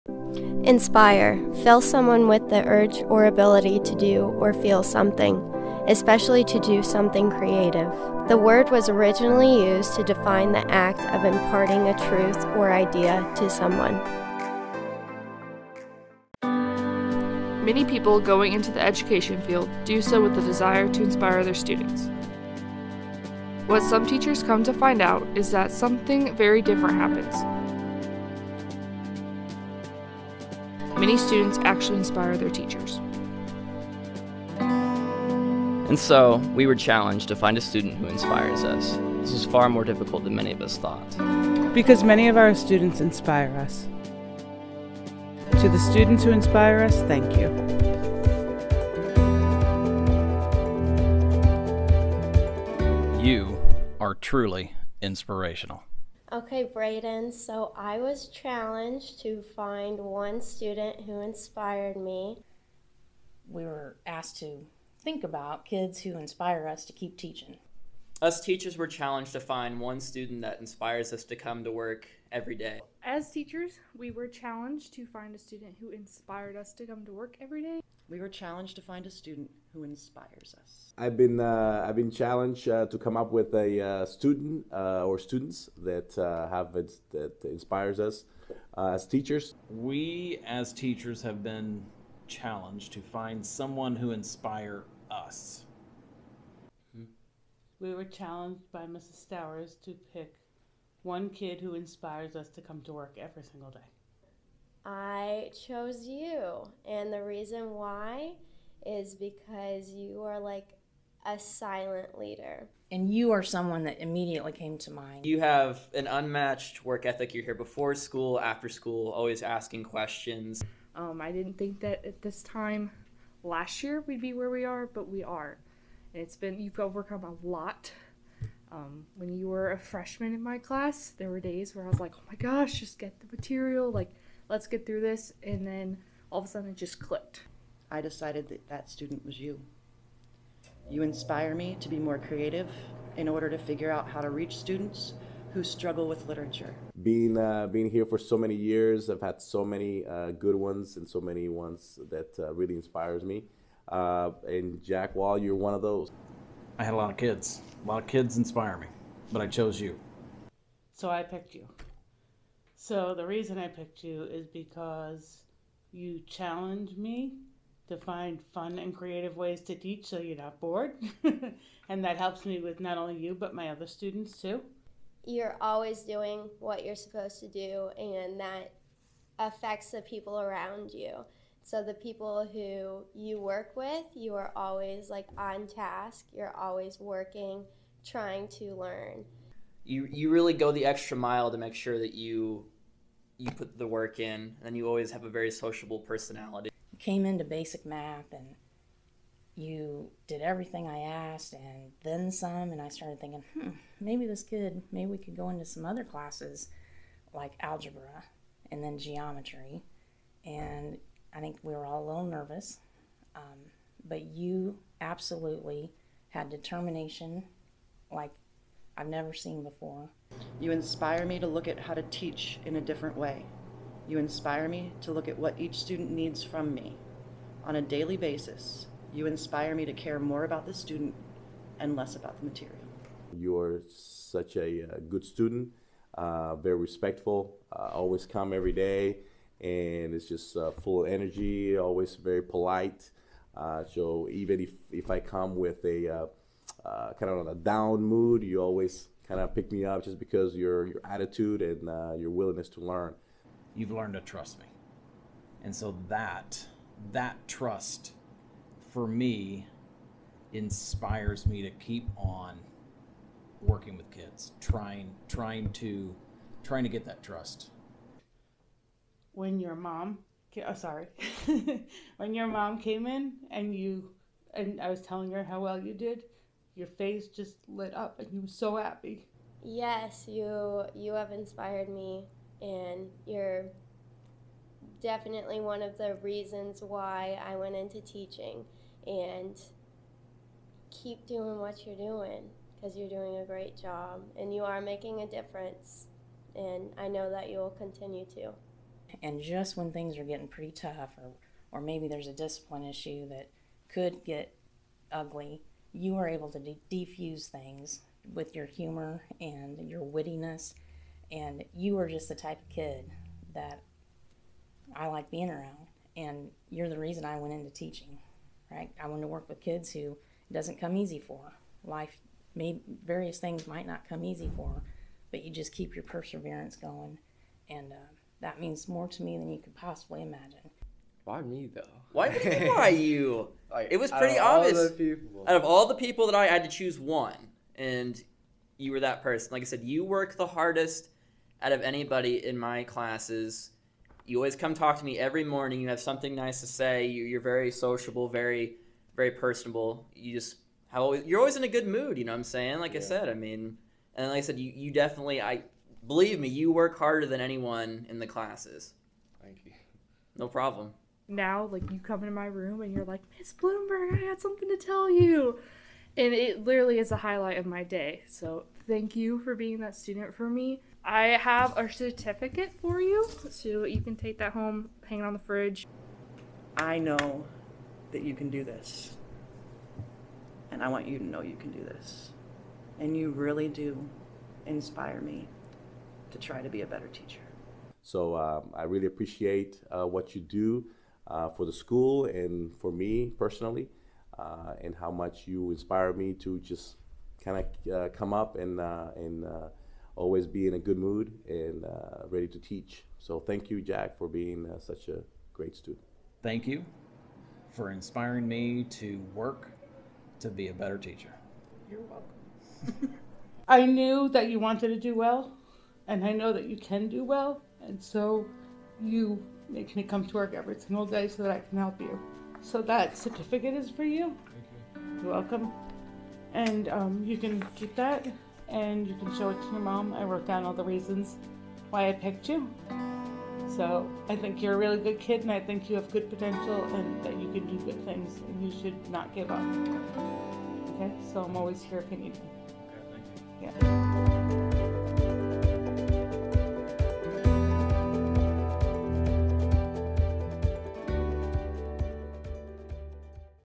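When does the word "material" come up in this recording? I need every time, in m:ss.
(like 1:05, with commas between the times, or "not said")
2:13, 3:52.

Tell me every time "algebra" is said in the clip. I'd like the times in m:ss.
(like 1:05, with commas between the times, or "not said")
3:27.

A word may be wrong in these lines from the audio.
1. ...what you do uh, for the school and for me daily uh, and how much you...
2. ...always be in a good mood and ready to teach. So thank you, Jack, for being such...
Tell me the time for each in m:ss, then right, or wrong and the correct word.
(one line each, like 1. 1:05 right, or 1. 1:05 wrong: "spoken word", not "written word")
1. 6:30 wrong: "personally", not "daily"
2. 6:40 right.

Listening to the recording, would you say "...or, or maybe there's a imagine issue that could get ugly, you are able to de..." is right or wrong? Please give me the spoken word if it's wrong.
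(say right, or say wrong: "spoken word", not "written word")
wrong: "discipline", not "imagine".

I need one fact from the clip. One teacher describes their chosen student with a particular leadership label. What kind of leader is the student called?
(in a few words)
silent leader.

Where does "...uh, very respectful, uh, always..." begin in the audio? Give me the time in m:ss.
3:56.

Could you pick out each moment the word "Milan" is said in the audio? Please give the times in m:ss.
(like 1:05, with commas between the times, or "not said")
not said.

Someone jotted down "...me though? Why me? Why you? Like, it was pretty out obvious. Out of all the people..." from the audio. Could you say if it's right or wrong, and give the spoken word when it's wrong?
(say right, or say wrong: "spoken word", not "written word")
right.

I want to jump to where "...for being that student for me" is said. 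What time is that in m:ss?
6:09.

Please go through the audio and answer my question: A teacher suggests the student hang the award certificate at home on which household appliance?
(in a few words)
the fridge.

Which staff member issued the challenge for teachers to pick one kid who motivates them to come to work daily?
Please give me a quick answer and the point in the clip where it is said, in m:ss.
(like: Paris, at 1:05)
Mrs. Stowers, at 1:38.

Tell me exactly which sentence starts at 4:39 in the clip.
Yes, you you have inspired me and you're definitely one of the reasons why I went into teaching.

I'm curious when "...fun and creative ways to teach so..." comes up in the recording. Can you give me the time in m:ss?
2:48.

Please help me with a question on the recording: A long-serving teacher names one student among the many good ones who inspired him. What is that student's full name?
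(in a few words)
Jack Wall.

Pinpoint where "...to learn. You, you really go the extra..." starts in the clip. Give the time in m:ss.
3:08.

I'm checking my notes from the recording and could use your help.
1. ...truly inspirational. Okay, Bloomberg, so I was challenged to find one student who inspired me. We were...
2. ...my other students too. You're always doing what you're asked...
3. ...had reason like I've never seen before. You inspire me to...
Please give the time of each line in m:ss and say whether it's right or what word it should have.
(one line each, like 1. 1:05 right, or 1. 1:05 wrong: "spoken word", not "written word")
1. 0:54 wrong: "Brayden", not "Bloomberg"
2. 2:53 wrong: "supposed", not "asked"
3. 3:36 wrong: "determination", not "reason".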